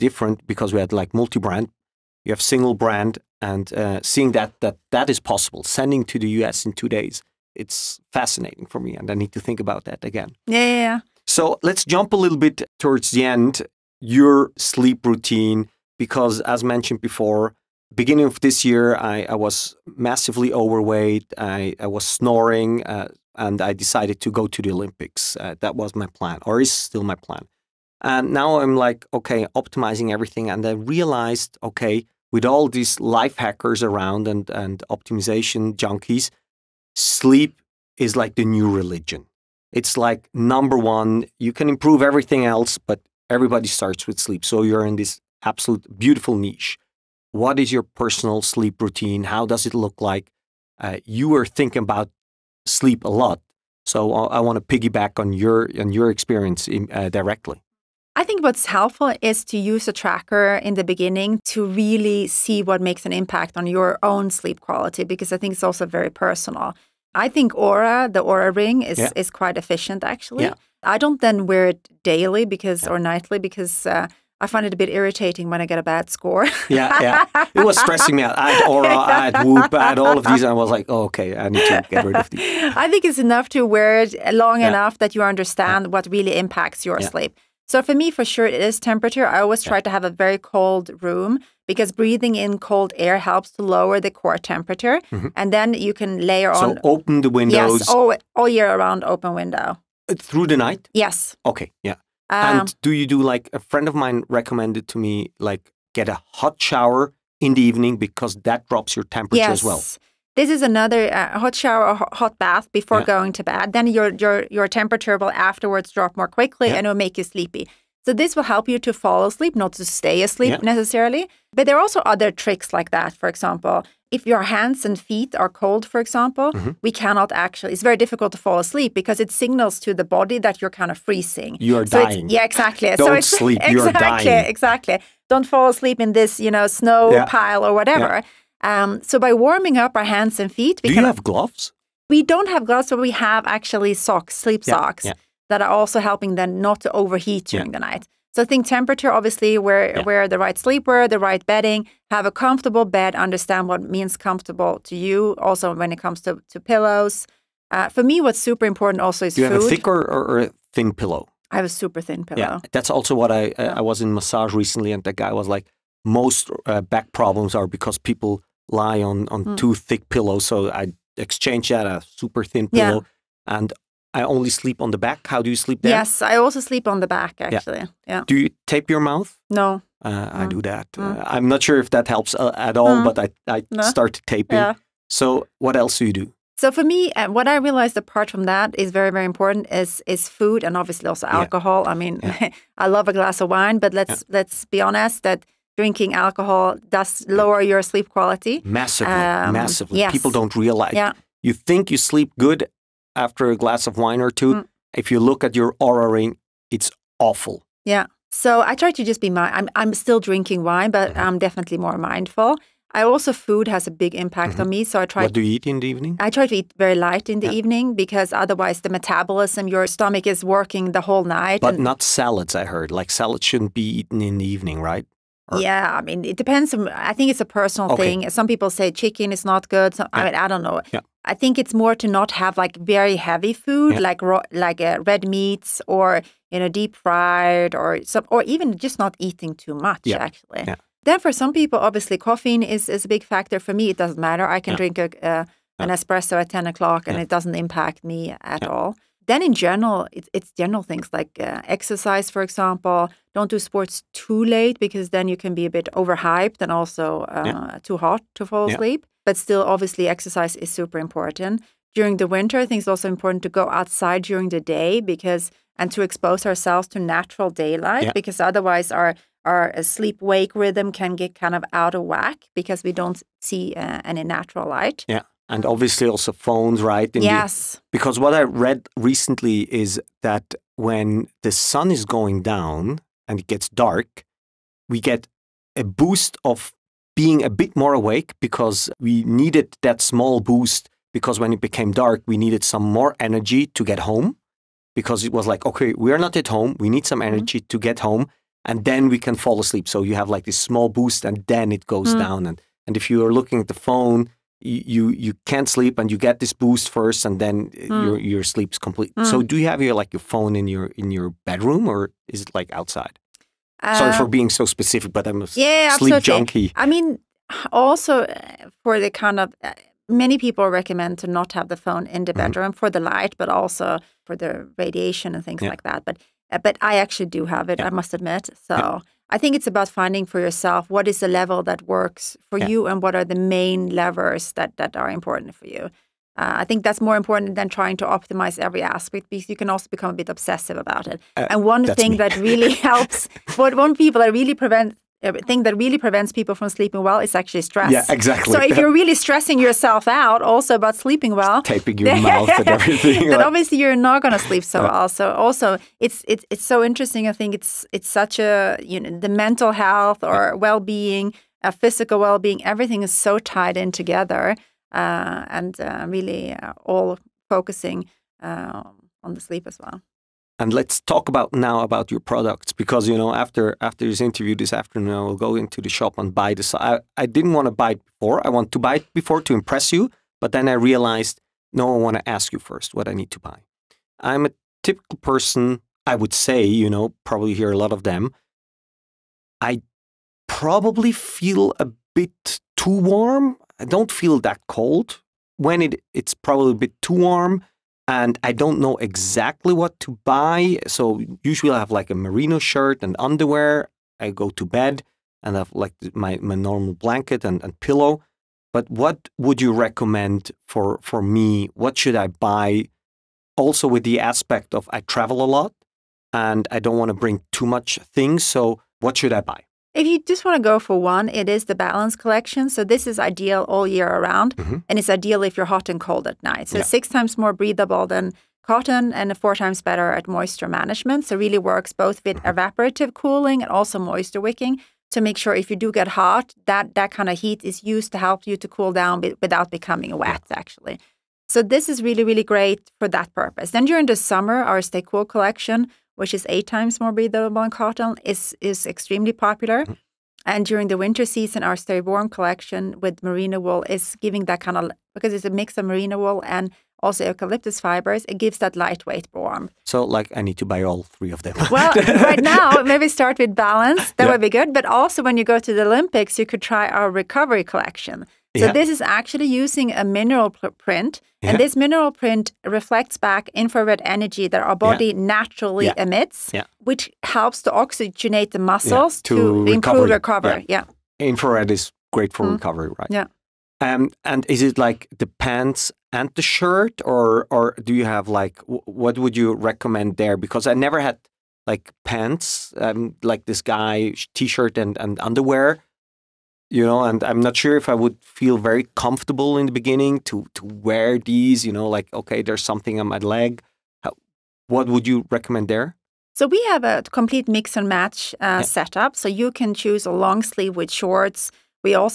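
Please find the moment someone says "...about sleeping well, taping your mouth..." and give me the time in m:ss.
5:50.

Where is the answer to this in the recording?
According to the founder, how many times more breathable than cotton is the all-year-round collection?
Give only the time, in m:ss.
7:06.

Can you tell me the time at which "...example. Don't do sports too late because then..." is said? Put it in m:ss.
4:12.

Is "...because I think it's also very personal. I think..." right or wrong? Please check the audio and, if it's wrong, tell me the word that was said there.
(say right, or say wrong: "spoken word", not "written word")
right.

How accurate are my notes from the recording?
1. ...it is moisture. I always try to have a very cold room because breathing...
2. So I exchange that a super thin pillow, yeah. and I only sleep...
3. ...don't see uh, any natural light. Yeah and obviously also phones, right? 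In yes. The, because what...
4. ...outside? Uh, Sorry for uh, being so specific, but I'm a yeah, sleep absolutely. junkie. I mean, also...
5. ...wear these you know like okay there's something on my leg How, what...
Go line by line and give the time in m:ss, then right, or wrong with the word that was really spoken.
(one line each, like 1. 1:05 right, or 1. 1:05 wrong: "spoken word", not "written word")
1. 1:28 wrong: "temperature", not "moisture"
2. 2:50 right
3. 4:32 right
4. 5:12 right
5. 8:20 right.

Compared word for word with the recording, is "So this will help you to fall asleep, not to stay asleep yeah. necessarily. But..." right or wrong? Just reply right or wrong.
right.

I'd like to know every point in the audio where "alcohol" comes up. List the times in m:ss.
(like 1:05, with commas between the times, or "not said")
3:11, 3:16.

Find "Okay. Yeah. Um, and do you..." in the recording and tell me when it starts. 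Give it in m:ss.
1:41.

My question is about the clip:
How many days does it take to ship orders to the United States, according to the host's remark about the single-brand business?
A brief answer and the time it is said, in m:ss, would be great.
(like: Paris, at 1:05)
2, at 0:06.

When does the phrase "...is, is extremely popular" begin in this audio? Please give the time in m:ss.
7:28.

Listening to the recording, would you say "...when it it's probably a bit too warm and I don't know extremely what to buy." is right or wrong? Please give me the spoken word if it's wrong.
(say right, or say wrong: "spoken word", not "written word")
wrong: "exactly", not "extremely".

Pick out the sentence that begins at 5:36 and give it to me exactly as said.
Uh, I think that's more important than trying to optimize every aspect because you can also become a bit obsessive about it.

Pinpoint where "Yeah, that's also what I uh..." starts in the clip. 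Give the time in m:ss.
2:42.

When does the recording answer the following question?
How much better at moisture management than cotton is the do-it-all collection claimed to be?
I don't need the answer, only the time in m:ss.
7:09.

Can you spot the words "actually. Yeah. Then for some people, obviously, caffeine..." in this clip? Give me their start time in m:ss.
4:00.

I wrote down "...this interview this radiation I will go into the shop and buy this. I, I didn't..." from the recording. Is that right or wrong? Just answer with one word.
wrong.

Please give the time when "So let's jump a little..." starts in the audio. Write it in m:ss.
0:11.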